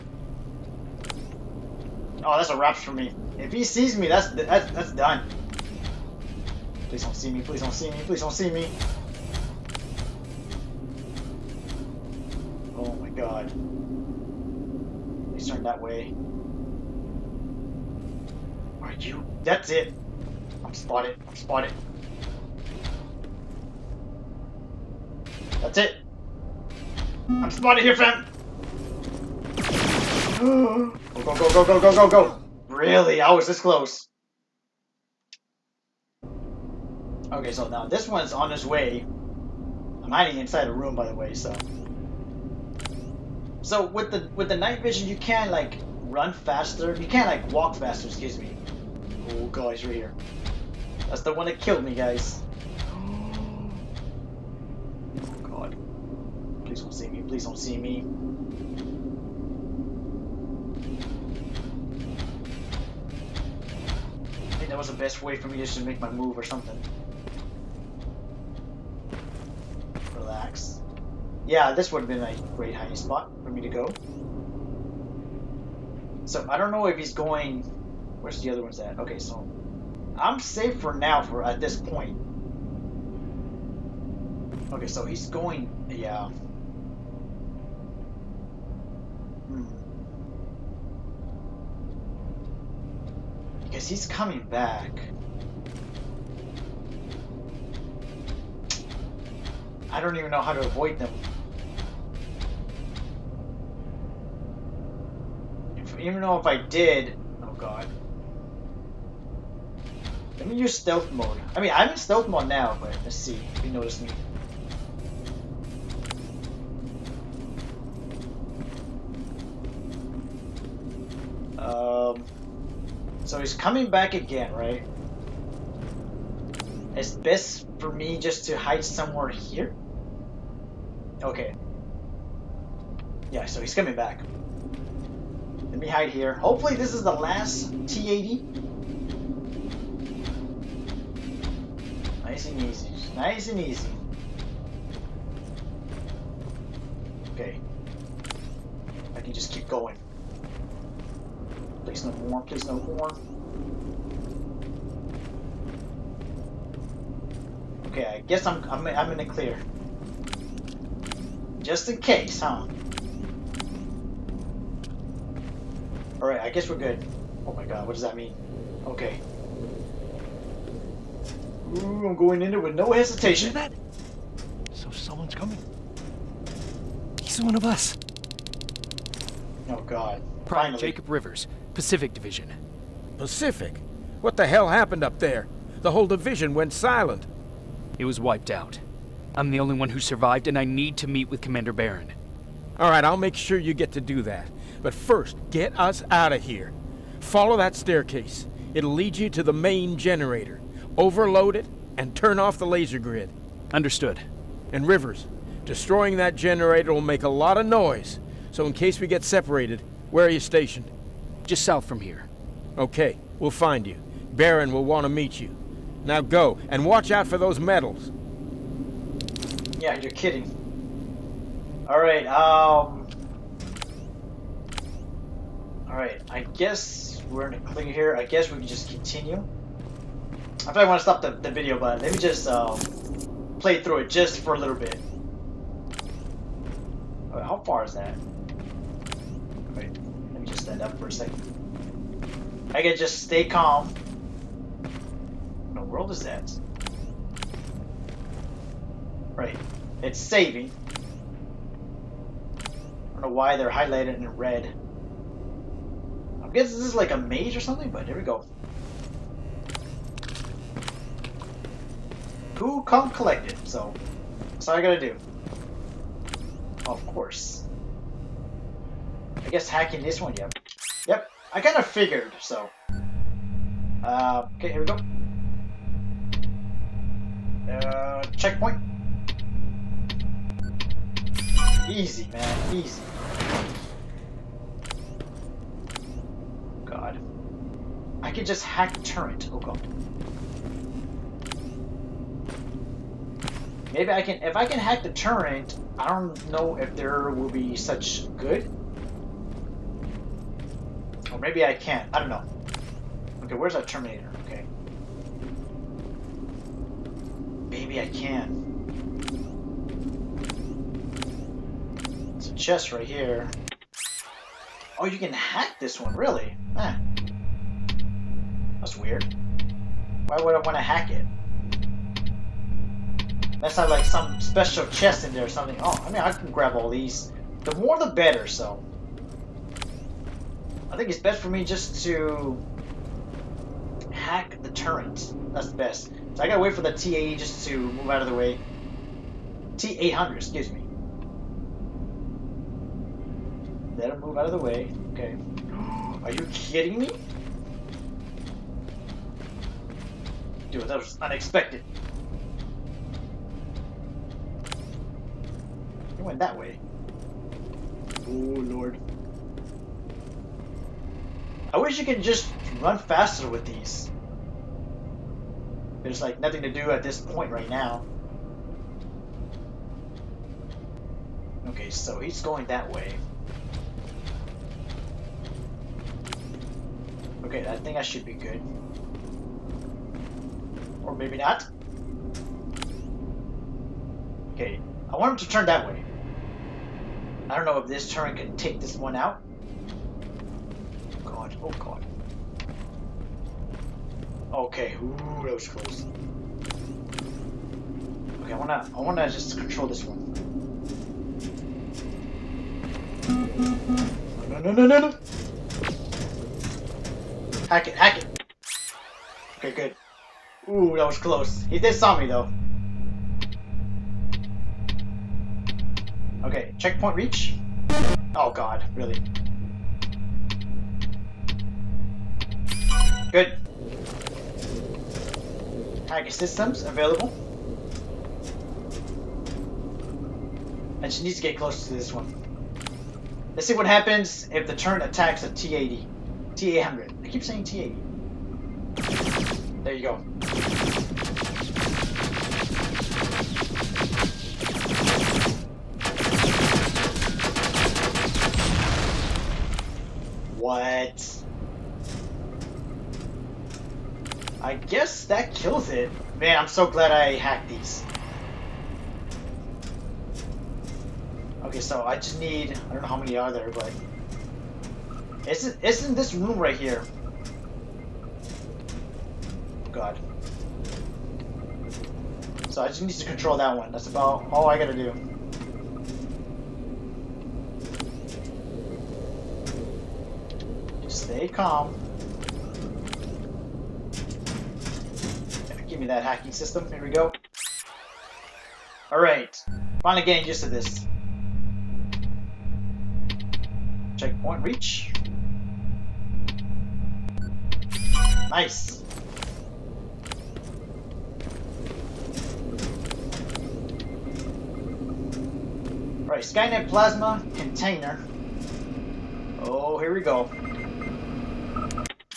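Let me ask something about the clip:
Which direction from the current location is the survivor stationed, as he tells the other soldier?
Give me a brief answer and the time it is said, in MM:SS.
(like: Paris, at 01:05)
south, at 03:31.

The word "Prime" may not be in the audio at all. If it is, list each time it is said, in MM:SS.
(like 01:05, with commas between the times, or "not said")
03:00.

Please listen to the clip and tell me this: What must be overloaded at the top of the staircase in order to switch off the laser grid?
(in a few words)
main generator.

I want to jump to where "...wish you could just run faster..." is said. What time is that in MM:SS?
06:01.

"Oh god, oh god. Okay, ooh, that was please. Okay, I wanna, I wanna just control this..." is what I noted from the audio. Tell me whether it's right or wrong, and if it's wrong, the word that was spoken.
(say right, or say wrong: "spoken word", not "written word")
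wrong: "close", not "please".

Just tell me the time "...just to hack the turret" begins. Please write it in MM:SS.
05:31.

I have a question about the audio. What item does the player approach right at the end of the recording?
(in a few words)
Skynet Plasma Container.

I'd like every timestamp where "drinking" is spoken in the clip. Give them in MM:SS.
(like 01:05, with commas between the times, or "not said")
not said.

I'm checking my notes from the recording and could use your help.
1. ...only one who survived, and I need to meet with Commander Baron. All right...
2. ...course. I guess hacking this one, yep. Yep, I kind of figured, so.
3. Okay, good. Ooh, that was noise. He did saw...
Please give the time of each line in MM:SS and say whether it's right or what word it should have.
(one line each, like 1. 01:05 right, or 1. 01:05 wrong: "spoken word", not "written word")
1. 03:09 right
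2. 04:27 right
3. 06:49 wrong: "close", not "noise".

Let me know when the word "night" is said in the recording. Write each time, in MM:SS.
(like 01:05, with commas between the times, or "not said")
00:44.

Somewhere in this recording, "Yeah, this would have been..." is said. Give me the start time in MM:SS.
01:11.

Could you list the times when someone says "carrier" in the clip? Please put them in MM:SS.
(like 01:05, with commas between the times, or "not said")
not said.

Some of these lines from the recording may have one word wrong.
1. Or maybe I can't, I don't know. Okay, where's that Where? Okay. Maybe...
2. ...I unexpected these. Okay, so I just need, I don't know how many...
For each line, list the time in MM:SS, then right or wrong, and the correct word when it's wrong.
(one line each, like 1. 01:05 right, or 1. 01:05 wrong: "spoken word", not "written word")
1. 05:01 wrong: "Terminator", not "Where"
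2. 07:37 wrong: "hacked", not "unexpected".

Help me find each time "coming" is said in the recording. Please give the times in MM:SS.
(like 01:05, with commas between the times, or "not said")
01:34, 02:03, 02:13, 02:55.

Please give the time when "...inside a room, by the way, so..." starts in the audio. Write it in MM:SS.
00:40.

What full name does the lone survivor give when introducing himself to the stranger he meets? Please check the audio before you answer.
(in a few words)
Jacob Rivers.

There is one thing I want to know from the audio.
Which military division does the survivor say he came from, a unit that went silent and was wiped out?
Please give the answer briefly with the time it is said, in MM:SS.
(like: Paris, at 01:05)
Pacific Division, at 03:01.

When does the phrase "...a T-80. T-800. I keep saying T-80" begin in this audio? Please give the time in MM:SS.
07:15.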